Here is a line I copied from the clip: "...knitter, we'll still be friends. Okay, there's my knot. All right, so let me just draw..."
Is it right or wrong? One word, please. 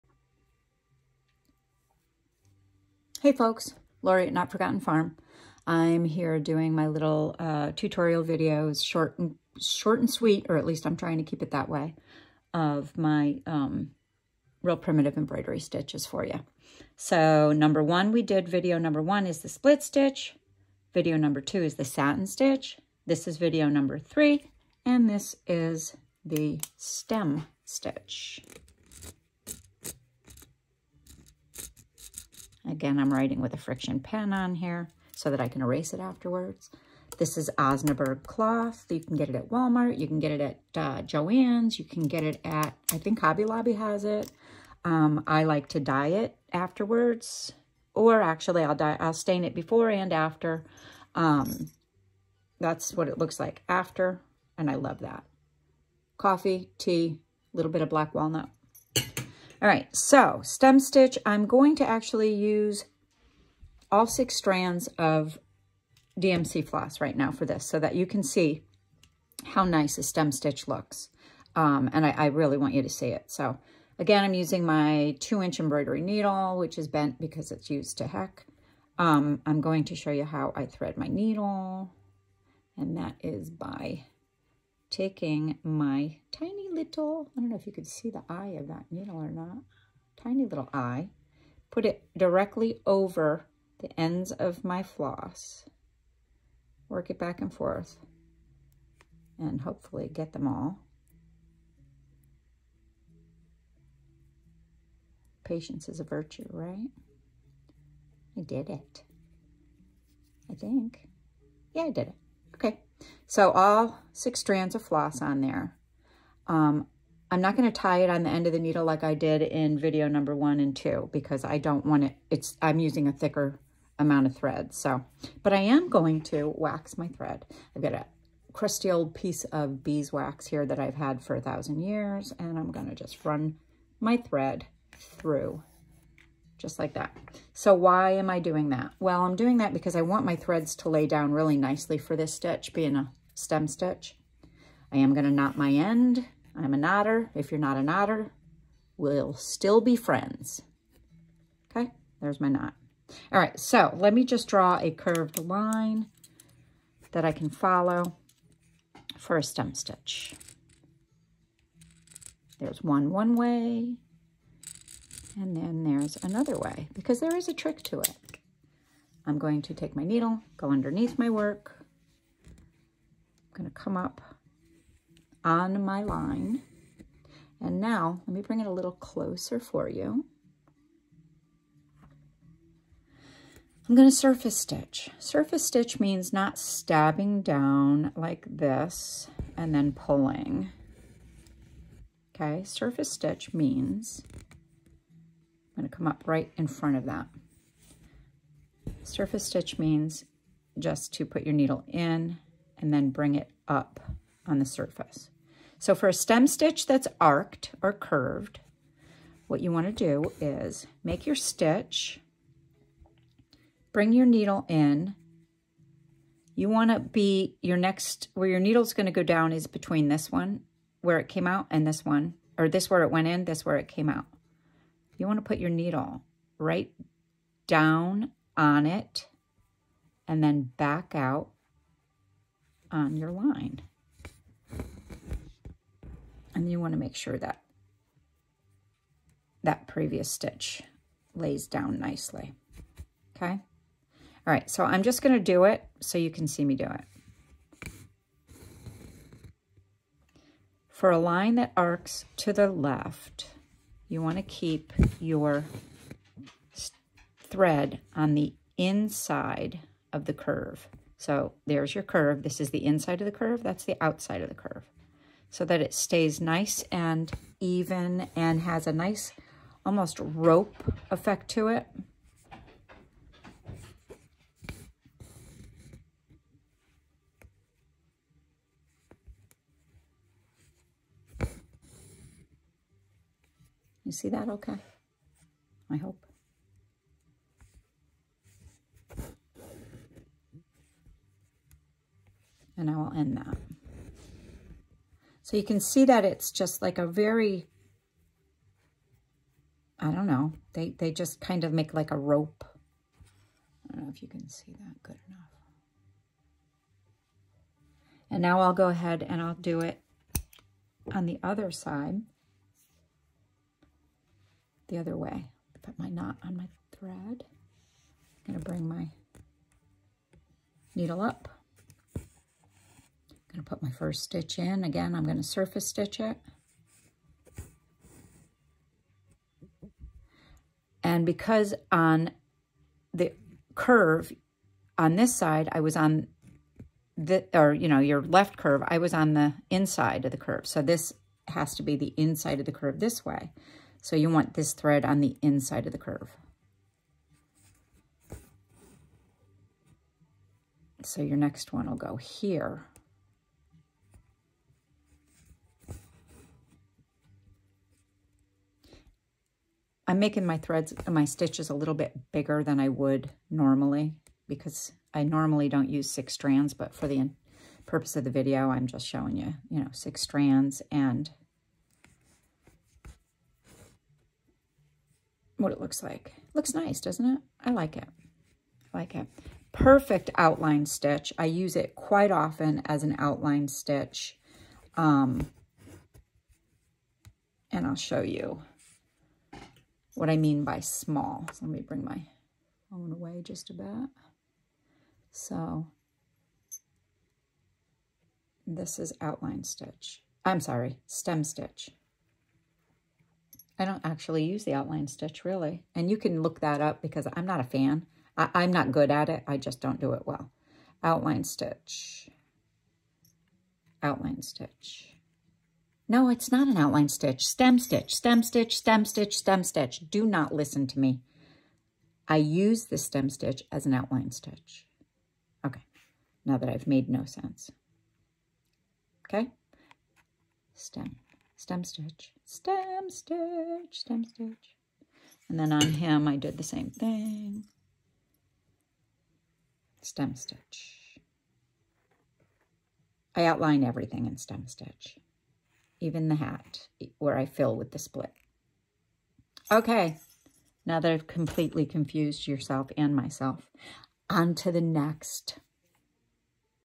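right.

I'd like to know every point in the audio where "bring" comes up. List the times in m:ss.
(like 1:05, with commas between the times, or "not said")
2:58, 3:23, 3:33, 5:18, 6:31.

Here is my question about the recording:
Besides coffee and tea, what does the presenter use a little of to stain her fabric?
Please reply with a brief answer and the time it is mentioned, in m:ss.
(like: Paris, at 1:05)
black walnut, at 0:57.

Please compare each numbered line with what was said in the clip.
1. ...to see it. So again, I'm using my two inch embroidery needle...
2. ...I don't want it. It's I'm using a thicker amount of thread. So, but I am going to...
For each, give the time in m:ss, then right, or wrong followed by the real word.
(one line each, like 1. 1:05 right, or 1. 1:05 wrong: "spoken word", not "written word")
1. 1:12 right
2. 2:01 right.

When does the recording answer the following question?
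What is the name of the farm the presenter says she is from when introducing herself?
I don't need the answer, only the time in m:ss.
0:04.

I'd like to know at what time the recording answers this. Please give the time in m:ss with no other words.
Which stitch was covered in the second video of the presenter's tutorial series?
0:21.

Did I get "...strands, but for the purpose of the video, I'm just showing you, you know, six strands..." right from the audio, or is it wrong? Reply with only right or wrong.
right.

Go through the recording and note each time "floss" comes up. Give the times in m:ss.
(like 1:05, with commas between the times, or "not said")
1:06, 1:34, 1:54.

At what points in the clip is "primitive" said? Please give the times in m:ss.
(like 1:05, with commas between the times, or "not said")
0:14.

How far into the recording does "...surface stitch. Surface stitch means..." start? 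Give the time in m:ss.
3:04.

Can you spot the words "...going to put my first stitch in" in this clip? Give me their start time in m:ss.
5:23.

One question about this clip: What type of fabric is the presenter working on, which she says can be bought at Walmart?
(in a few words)
Osnaburg cloth.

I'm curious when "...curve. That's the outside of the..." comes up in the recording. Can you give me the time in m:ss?
4:23.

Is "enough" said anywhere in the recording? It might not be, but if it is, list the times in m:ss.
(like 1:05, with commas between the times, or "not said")
5:05.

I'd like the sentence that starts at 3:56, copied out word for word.
And you want to make sure that that previous stitch lays down nicely.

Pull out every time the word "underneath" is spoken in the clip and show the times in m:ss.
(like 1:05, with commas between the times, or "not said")
2:50.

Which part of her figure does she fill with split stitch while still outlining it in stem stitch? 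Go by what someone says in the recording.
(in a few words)
the hat.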